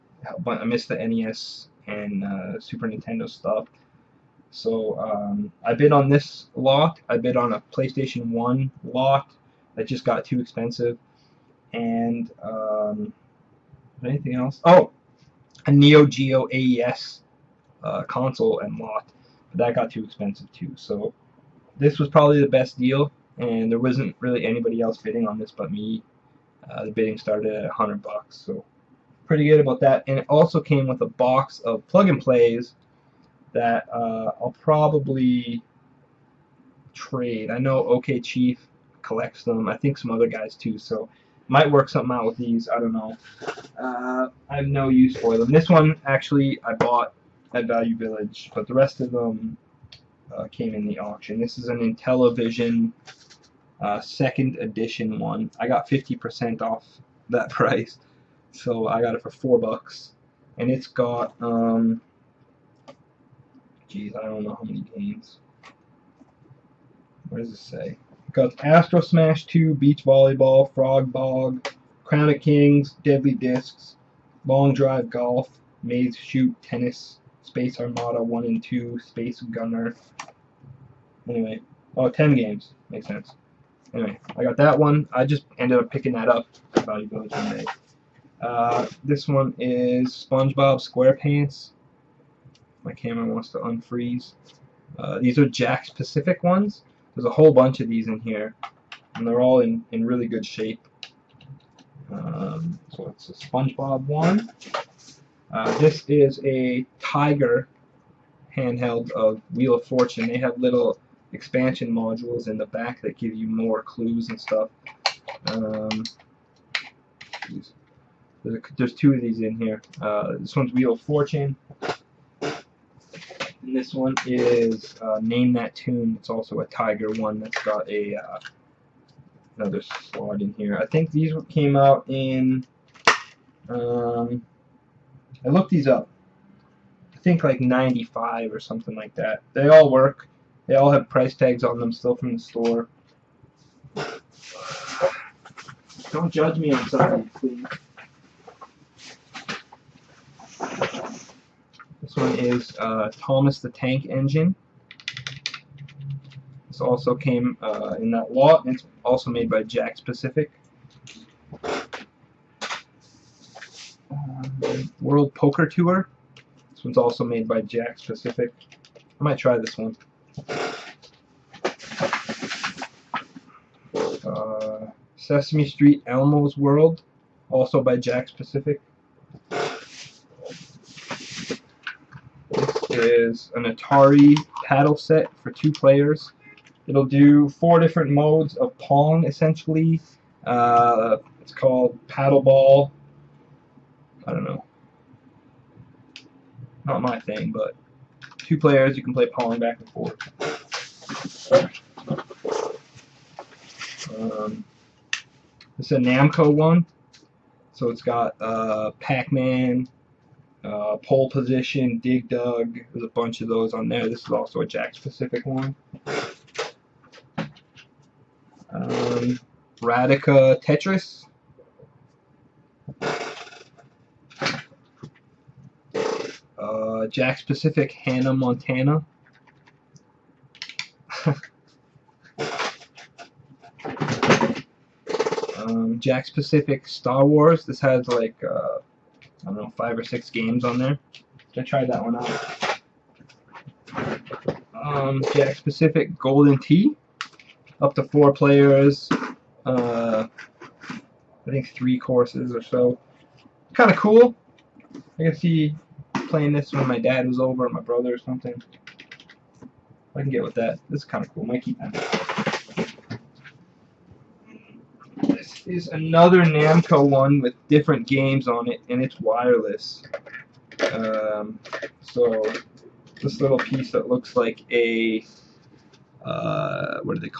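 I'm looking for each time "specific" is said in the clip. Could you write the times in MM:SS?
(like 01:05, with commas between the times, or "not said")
03:56, 04:05.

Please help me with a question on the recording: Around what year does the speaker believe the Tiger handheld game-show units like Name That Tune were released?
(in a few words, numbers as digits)
1995.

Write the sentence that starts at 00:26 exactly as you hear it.
Uh, the bidding started at 100 bucks, so pretty good about that.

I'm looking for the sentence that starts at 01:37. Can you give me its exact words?
There's a whole bunch of these in here, and they're all in, in really good shape.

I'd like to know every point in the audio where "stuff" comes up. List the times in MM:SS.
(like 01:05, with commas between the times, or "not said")
00:03, 01:54.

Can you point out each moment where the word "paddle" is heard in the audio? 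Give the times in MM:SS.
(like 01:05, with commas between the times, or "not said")
03:04, 03:12.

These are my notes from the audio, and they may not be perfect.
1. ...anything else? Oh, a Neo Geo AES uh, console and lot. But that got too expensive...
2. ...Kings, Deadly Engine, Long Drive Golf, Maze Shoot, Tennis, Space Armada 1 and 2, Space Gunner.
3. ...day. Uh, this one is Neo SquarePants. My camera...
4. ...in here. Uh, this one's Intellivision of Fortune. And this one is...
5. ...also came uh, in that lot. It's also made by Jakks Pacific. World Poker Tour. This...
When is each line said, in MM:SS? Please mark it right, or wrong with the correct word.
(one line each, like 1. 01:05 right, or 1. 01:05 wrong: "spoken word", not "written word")
1. 00:14 right
2. 01:12 wrong: "Discs", not "Engine"
3. 01:27 wrong: "SpongeBob", not "Neo"
4. 01:59 wrong: "Wheel", not "Intellivision"
5. 02:36 right.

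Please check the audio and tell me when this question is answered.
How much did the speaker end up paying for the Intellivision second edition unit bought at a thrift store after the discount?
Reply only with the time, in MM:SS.
00:59.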